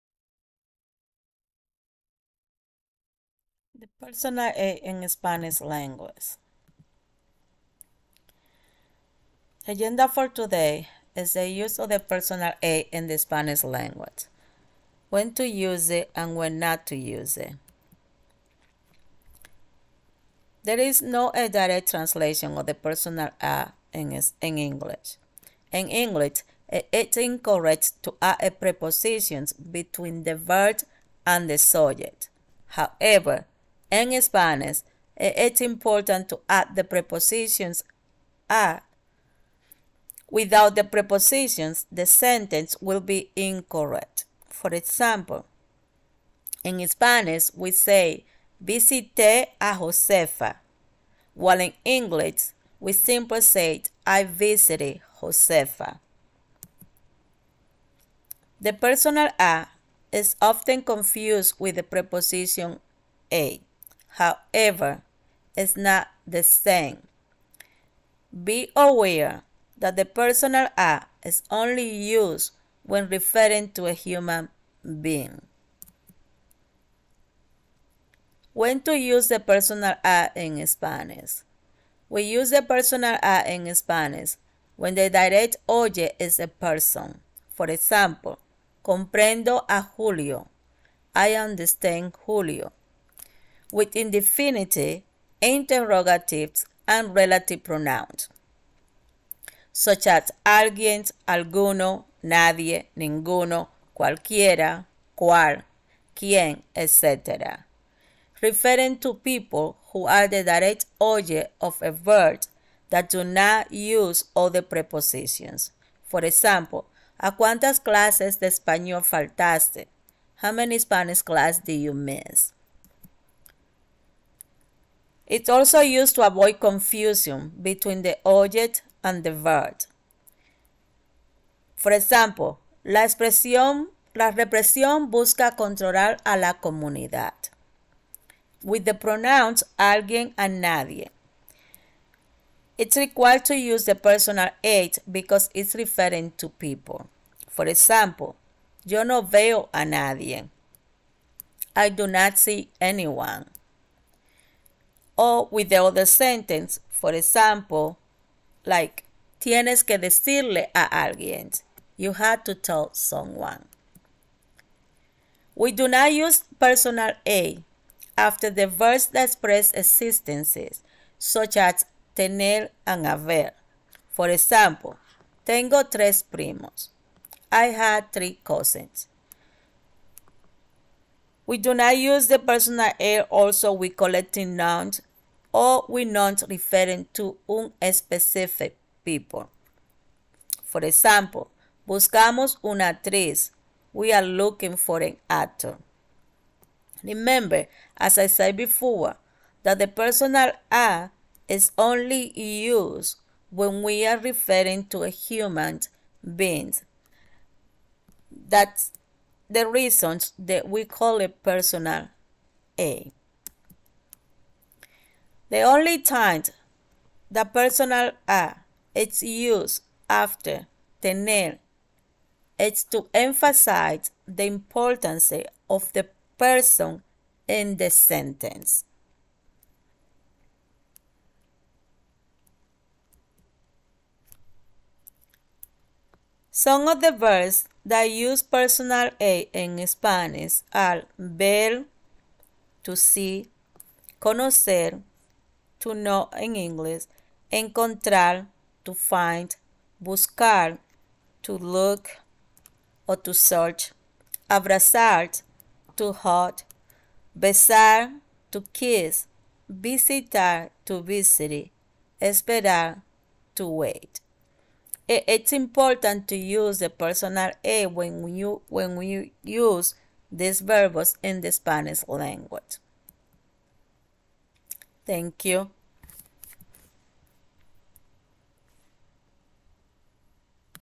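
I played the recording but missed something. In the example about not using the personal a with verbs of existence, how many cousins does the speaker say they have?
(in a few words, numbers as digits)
3.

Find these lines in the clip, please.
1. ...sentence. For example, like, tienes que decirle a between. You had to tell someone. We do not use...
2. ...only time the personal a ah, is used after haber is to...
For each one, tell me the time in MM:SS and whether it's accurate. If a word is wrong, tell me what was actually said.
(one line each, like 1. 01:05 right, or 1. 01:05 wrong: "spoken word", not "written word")
1. 02:36 wrong: "alguien", not "between"
2. 03:35 wrong: "tener", not "haber".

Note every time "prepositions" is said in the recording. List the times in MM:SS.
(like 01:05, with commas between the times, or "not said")
00:28, 00:36, 00:40, 01:01, 01:54.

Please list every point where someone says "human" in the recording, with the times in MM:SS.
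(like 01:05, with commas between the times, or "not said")
01:13, 03:25.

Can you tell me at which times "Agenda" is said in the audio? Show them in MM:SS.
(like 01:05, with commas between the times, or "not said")
00:09.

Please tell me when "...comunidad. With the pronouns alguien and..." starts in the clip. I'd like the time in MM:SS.
02:16.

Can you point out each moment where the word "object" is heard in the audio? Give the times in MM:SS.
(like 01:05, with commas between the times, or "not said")
01:50, 02:08.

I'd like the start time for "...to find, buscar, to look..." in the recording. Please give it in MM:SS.
04:08.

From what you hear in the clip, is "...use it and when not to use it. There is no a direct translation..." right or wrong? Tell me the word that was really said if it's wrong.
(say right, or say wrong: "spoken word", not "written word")
right.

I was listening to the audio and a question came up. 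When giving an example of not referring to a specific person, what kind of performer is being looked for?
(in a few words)
una actriz.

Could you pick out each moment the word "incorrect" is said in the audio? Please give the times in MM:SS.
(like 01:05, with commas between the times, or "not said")
00:27, 00:43.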